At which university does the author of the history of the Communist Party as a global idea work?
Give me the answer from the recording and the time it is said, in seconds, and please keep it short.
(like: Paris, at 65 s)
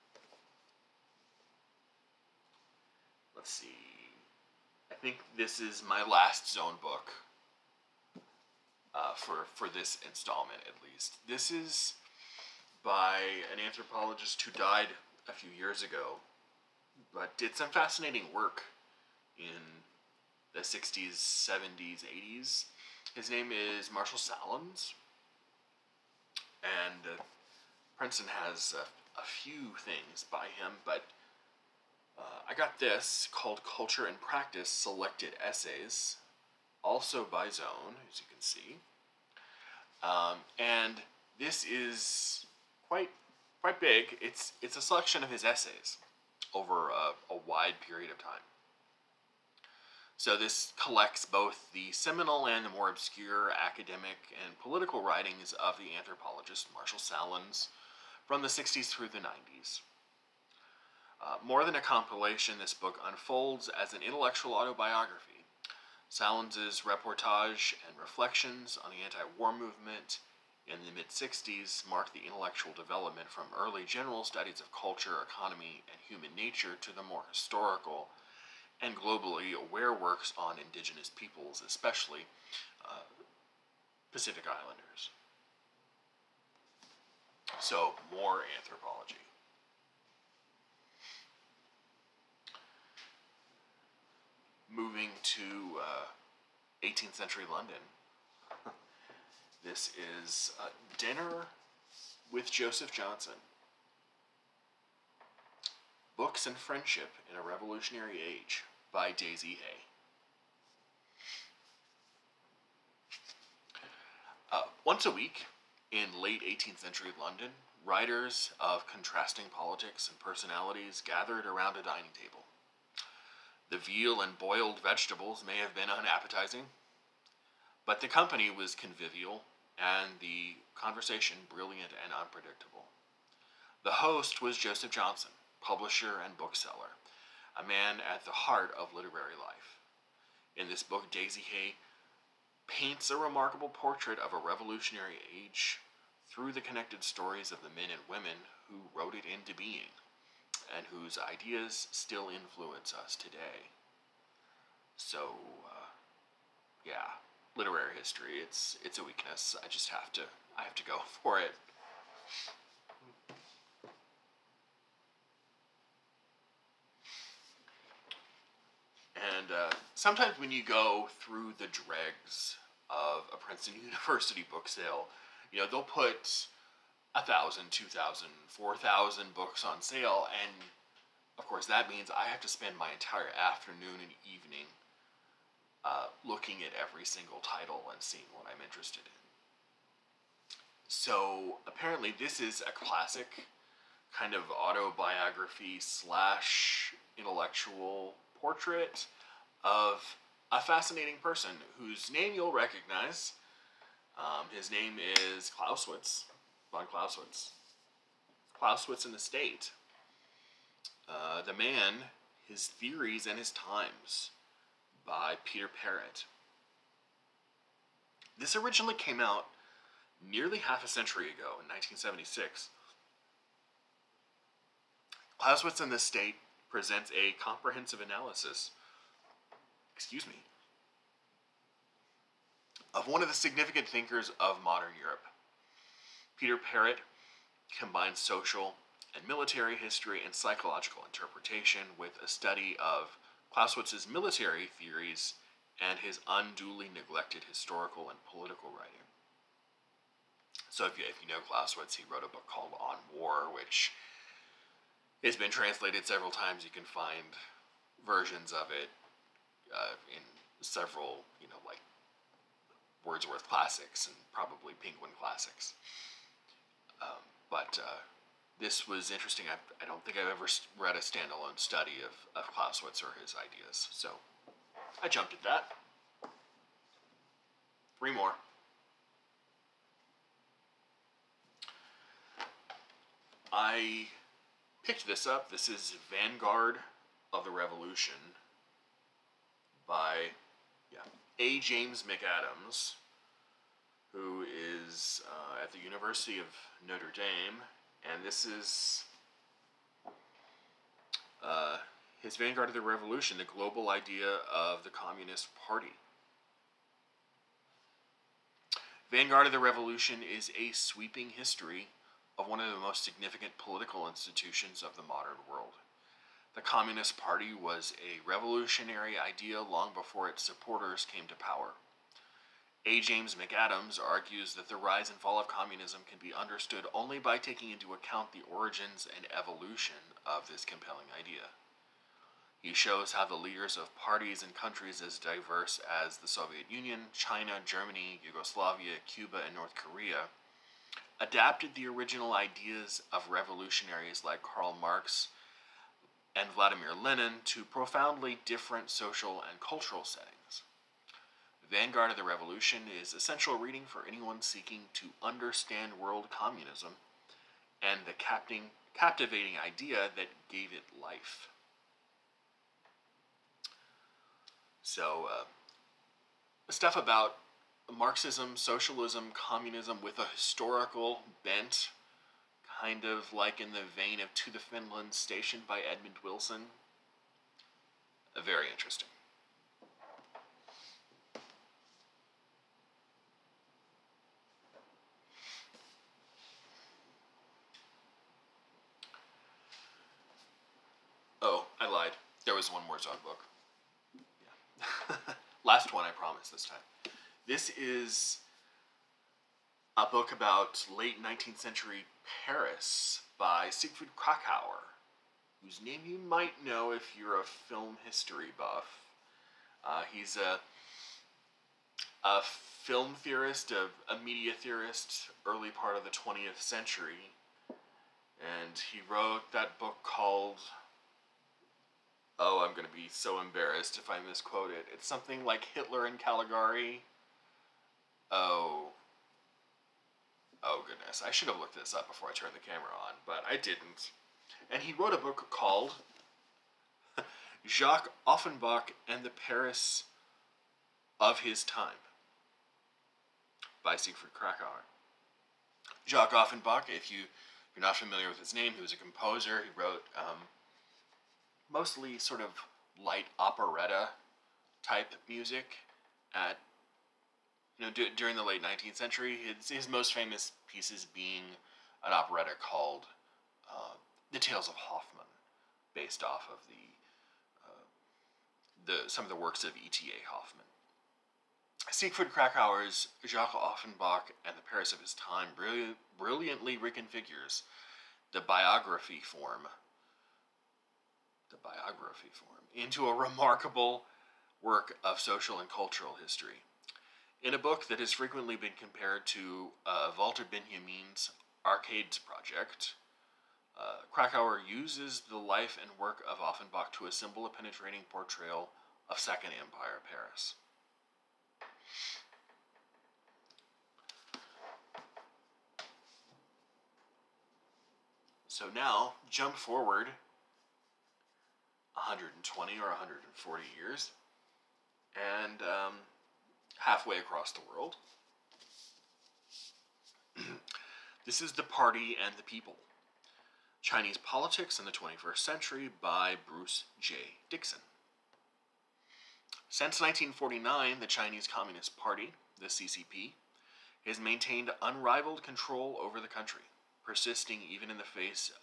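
University of Notre Dame, at 295 s.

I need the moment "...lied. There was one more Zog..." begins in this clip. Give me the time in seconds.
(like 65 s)
391 s.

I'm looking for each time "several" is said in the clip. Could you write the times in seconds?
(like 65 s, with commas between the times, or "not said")
256 s, 260 s.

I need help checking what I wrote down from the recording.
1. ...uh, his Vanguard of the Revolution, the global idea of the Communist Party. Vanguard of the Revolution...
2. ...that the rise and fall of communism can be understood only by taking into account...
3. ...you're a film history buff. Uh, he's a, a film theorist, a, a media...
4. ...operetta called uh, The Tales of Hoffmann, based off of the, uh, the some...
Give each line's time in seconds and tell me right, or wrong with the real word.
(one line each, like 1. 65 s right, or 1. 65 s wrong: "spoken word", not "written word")
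1. 301 s right
2. 324 s right
3. 407 s right
4. 462 s right.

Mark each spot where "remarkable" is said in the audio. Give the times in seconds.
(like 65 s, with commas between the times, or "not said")
143 s, 483 s.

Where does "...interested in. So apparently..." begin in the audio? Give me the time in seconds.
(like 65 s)
188 s.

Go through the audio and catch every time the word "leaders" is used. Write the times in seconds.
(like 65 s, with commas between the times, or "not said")
333 s.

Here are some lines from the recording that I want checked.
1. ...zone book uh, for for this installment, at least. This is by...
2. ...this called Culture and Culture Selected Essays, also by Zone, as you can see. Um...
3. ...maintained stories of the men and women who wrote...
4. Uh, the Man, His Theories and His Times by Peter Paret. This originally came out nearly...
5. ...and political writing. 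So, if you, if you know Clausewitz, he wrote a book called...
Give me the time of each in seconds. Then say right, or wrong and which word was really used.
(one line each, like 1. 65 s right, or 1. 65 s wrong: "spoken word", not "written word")
1. 6 s right
2. 32 s wrong: "Practice", not "Culture"
3. 146 s wrong: "connected", not "maintained"
4. 211 s right
5. 248 s right.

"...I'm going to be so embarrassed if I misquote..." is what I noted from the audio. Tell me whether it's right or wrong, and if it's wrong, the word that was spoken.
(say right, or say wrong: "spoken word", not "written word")
right.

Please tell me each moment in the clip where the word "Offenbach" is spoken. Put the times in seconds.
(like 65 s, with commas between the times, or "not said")
438 s, 446 s, 473 s, 496 s.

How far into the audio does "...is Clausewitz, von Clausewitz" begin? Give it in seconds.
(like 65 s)
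205 s.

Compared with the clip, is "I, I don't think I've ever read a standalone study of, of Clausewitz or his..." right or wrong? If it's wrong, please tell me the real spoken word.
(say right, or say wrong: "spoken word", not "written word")
right.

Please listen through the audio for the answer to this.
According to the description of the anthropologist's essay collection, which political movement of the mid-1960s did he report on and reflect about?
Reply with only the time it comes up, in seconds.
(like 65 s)
69 s.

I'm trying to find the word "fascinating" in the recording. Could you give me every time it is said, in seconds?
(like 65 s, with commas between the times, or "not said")
17 s, 200 s.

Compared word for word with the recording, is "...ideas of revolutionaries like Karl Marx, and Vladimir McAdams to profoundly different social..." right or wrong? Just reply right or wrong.
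wrong.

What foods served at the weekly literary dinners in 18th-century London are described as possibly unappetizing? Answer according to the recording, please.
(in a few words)
veal and boiled vegetables.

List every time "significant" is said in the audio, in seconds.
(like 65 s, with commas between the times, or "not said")
233 s, 313 s.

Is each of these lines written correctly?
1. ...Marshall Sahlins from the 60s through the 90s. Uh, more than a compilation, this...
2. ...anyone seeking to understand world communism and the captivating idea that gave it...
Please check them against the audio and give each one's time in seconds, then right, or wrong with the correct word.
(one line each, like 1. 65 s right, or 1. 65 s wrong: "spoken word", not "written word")
1. 56 s right
2. 354 s right.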